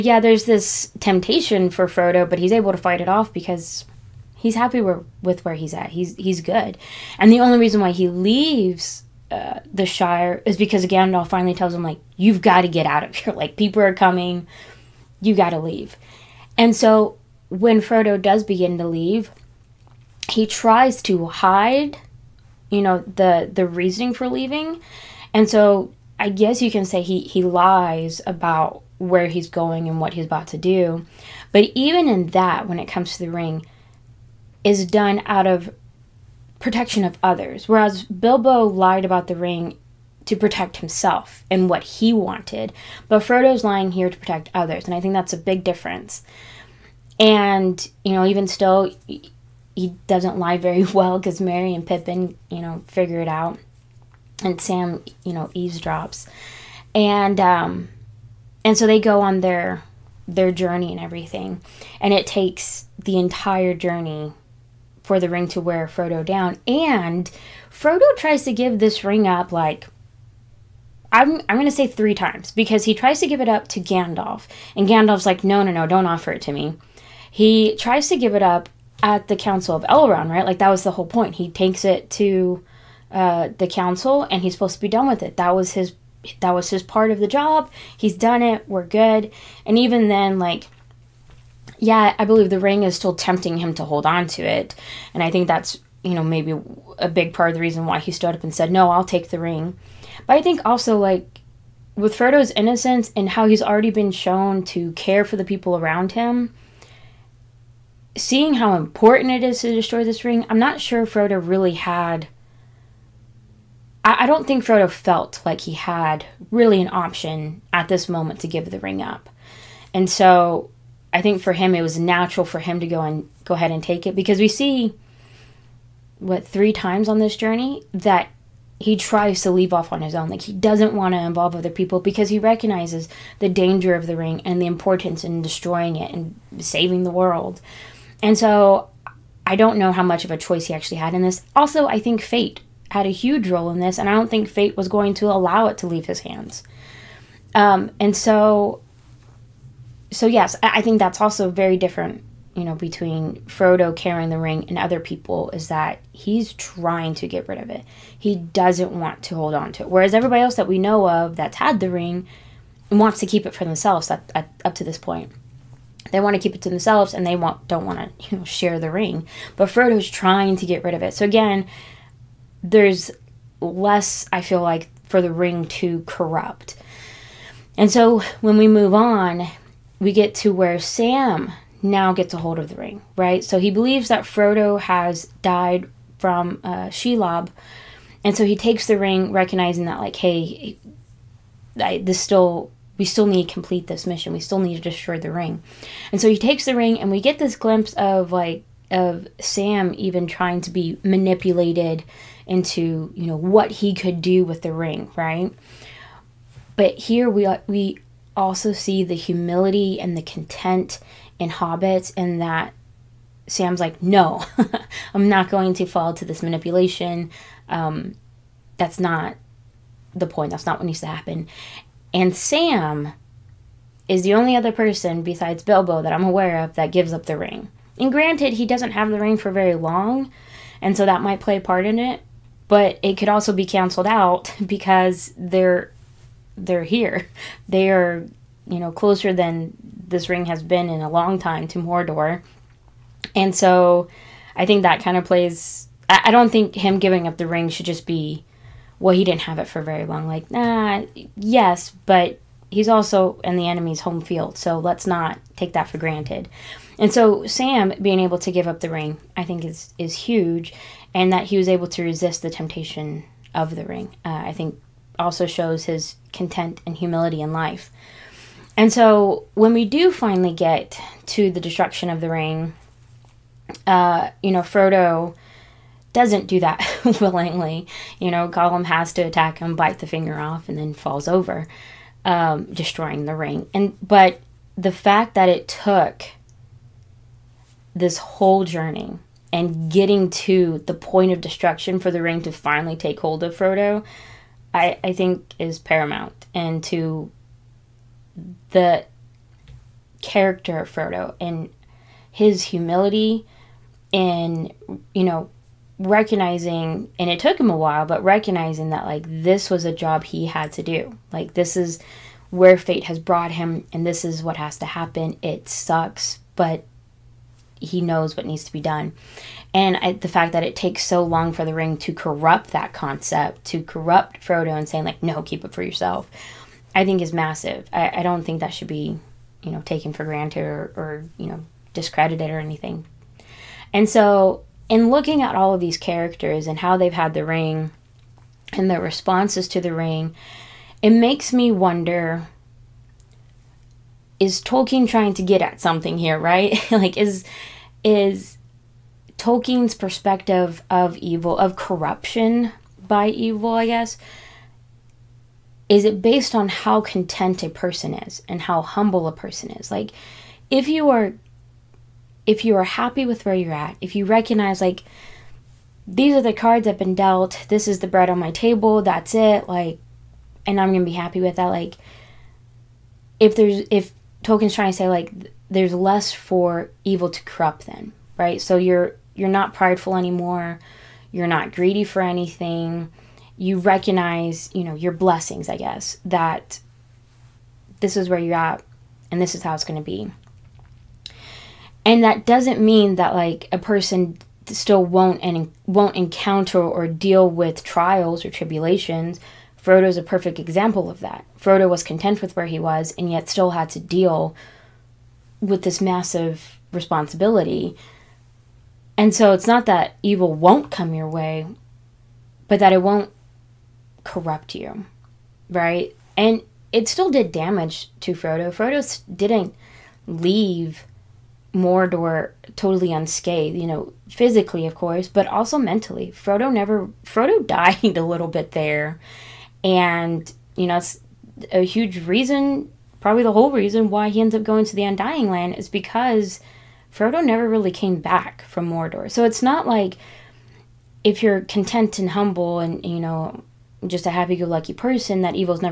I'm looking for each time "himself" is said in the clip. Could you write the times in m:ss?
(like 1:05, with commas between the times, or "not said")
0:40.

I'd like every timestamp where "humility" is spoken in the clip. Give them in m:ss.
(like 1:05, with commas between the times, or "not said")
3:29, 4:26, 5:02.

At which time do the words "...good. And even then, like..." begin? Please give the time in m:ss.
1:28.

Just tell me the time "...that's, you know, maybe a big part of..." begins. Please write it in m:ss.
1:35.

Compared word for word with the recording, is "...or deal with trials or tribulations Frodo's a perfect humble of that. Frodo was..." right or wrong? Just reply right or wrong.
wrong.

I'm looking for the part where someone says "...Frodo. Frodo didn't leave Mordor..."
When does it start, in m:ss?
6:58.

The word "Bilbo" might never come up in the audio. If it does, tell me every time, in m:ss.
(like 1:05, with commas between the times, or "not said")
0:38, 3:45.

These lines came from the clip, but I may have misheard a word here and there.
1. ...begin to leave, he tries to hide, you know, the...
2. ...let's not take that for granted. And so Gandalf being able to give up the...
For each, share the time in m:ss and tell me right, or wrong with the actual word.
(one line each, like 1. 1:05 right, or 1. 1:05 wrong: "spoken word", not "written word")
1. 0:18 right
2. 4:14 wrong: "Sam", not "Gandalf".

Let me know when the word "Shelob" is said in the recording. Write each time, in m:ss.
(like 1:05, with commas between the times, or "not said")
3:06.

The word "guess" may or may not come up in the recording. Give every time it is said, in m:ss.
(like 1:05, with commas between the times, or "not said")
0:26, 5:53, 6:25.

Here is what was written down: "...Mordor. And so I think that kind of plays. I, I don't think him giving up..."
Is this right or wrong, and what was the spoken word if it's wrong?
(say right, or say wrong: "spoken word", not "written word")
right.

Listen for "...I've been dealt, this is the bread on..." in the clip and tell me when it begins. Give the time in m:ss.
6:06.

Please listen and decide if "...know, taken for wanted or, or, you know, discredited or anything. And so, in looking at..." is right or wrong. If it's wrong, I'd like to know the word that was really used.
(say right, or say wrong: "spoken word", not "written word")
wrong: "granted", not "wanted".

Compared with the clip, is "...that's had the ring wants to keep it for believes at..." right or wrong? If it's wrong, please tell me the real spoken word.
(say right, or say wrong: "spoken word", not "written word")
wrong: "themselves", not "believes".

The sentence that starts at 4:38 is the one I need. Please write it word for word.
You know, Gollum has to attack him, bite the finger off, and then falls over, um, destroying the ring.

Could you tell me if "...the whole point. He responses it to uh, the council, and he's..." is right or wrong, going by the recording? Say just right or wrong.
wrong.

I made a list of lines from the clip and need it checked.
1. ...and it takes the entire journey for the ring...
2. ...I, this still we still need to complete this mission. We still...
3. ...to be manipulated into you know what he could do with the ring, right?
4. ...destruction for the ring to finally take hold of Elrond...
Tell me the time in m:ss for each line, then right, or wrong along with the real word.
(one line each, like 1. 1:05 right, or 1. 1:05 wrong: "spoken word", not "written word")
1. 1:02 right
2. 3:11 right
3. 3:20 right
4. 4:51 wrong: "Frodo", not "Elrond".